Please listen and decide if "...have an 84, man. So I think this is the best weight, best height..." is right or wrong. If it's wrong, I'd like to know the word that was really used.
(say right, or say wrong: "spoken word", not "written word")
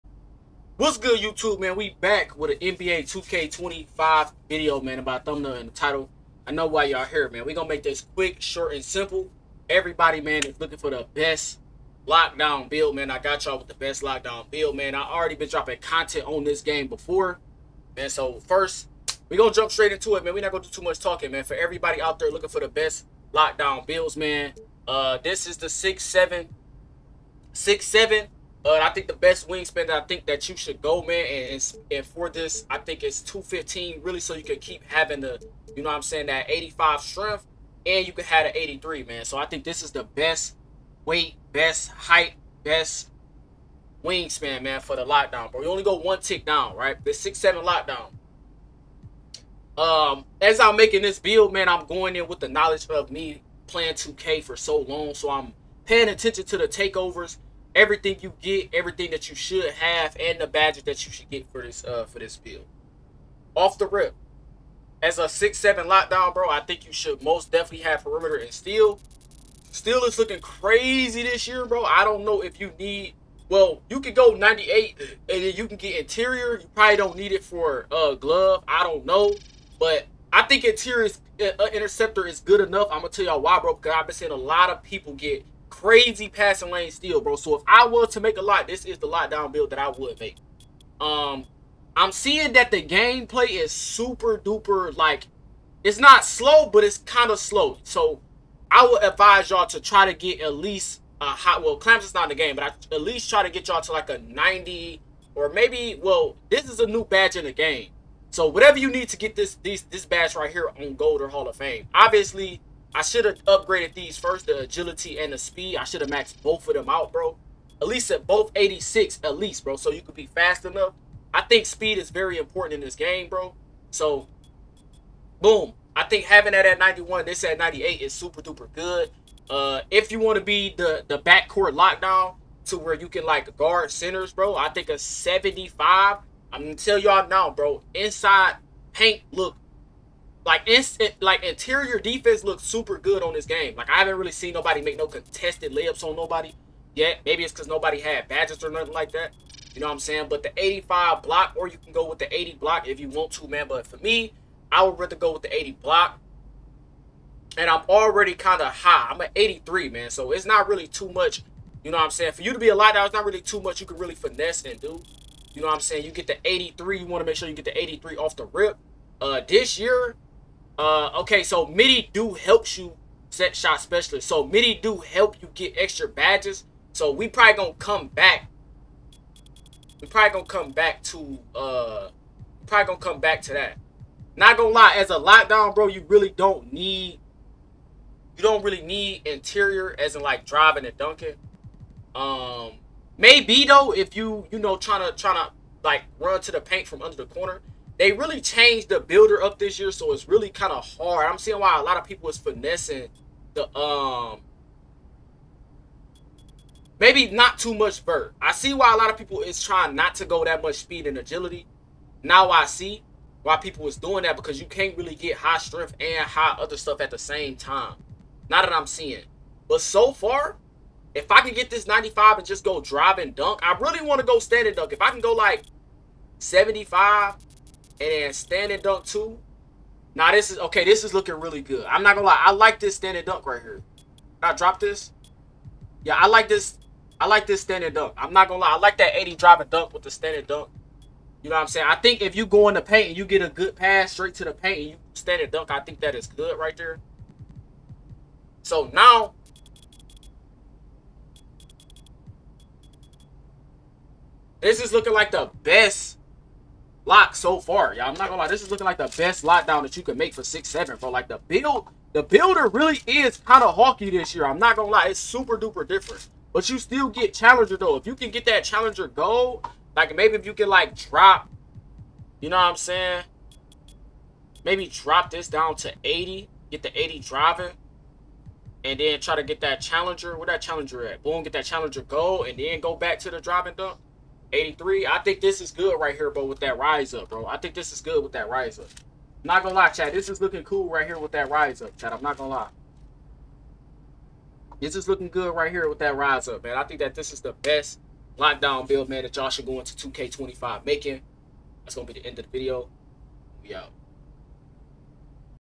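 wrong: "83", not "84".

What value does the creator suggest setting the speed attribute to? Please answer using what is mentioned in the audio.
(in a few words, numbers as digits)
91.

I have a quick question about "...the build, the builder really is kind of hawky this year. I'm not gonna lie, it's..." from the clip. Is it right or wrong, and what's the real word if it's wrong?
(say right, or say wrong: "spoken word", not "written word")
right.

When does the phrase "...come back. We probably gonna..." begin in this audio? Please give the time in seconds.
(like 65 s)
177 s.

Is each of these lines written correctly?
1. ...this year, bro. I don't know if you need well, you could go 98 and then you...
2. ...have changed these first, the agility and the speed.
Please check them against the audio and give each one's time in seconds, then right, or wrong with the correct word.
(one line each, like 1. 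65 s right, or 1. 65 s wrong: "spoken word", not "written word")
1. 71 s right
2. 113 s wrong: "upgraded", not "changed".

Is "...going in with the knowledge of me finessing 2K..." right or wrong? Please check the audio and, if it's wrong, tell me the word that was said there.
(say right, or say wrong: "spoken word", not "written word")
wrong: "playing", not "finessing".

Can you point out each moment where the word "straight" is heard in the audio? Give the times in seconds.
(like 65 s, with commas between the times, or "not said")
19 s, 244 s.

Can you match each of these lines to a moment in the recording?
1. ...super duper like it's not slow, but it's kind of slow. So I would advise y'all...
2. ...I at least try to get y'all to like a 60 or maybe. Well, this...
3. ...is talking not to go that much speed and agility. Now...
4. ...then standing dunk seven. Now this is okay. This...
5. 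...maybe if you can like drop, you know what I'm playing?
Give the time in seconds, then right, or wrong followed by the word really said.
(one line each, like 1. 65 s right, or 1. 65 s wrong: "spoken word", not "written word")
1. 93 s right
2. 102 s wrong: "90", not "60"
3. 209 s wrong: "trying", not "talking"
4. 228 s wrong: "two", not "seven"
5. 270 s wrong: "saying", not "playing".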